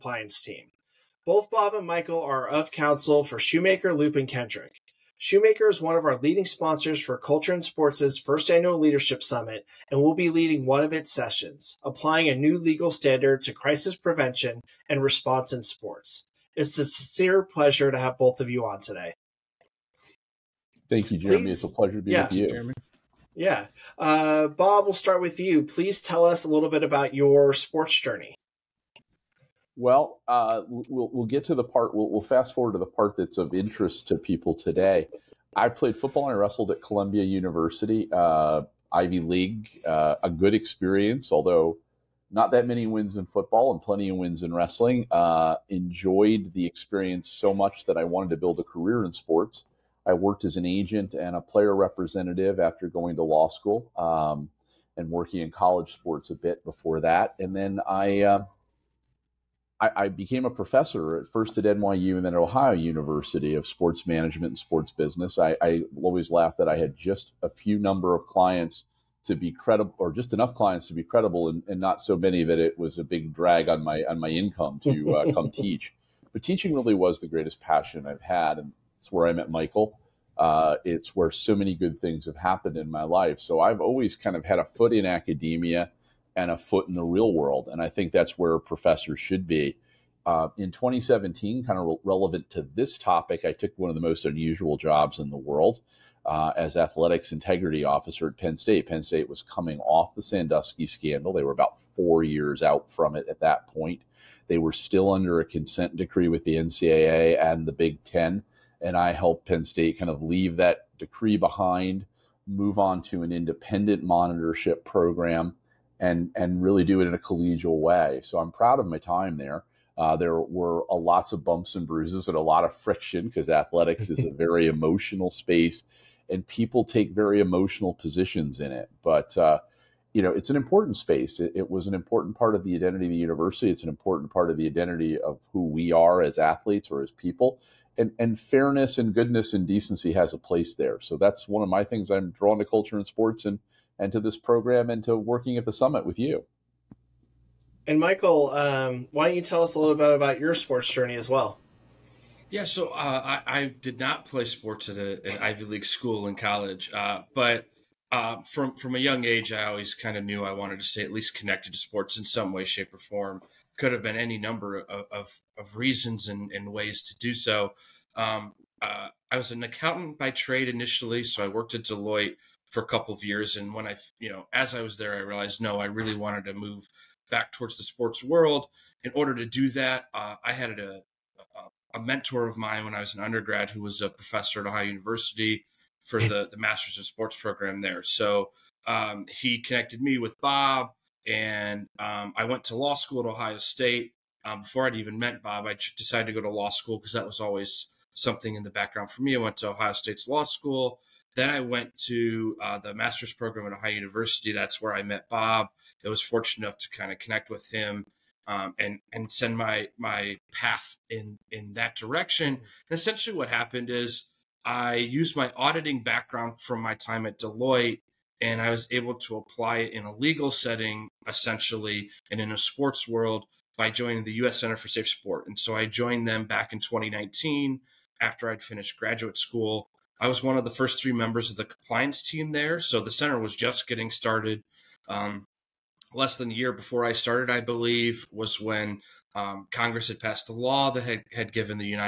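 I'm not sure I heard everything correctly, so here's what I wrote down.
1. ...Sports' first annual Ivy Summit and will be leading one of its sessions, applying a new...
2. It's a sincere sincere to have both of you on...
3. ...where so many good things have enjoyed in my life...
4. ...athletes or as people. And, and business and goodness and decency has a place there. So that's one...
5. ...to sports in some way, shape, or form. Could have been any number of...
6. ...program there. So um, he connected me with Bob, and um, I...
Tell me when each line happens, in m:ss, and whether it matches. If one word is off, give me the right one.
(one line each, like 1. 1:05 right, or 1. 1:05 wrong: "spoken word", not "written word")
1. 0:07 wrong: "Leadership", not "Ivy"
2. 0:16 wrong: "pleasure", not "sincere"
3. 1:21 wrong: "happened", not "enjoyed"
4. 2:16 wrong: "fairness", not "business"
5. 2:41 right
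6. 3:07 right.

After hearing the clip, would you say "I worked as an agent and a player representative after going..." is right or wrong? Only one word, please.
right.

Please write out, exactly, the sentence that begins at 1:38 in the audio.
Penn State was coming off the Sandusky scandal.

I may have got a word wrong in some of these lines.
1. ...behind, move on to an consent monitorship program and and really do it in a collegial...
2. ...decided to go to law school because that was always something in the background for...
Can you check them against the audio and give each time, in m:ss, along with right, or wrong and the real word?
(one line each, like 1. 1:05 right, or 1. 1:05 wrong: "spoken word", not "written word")
1. 1:51 wrong: "independent", not "consent"
2. 3:15 right.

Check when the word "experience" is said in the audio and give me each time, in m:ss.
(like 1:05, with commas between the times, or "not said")
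0:40, 0:46.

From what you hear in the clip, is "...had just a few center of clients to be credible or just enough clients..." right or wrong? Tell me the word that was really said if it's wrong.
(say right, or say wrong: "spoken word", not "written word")
wrong: "number", not "center".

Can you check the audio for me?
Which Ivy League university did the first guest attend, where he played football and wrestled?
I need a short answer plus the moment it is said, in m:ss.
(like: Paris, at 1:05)
Columbia University, at 0:36.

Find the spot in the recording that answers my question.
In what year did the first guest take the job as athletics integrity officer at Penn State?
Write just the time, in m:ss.
1:30.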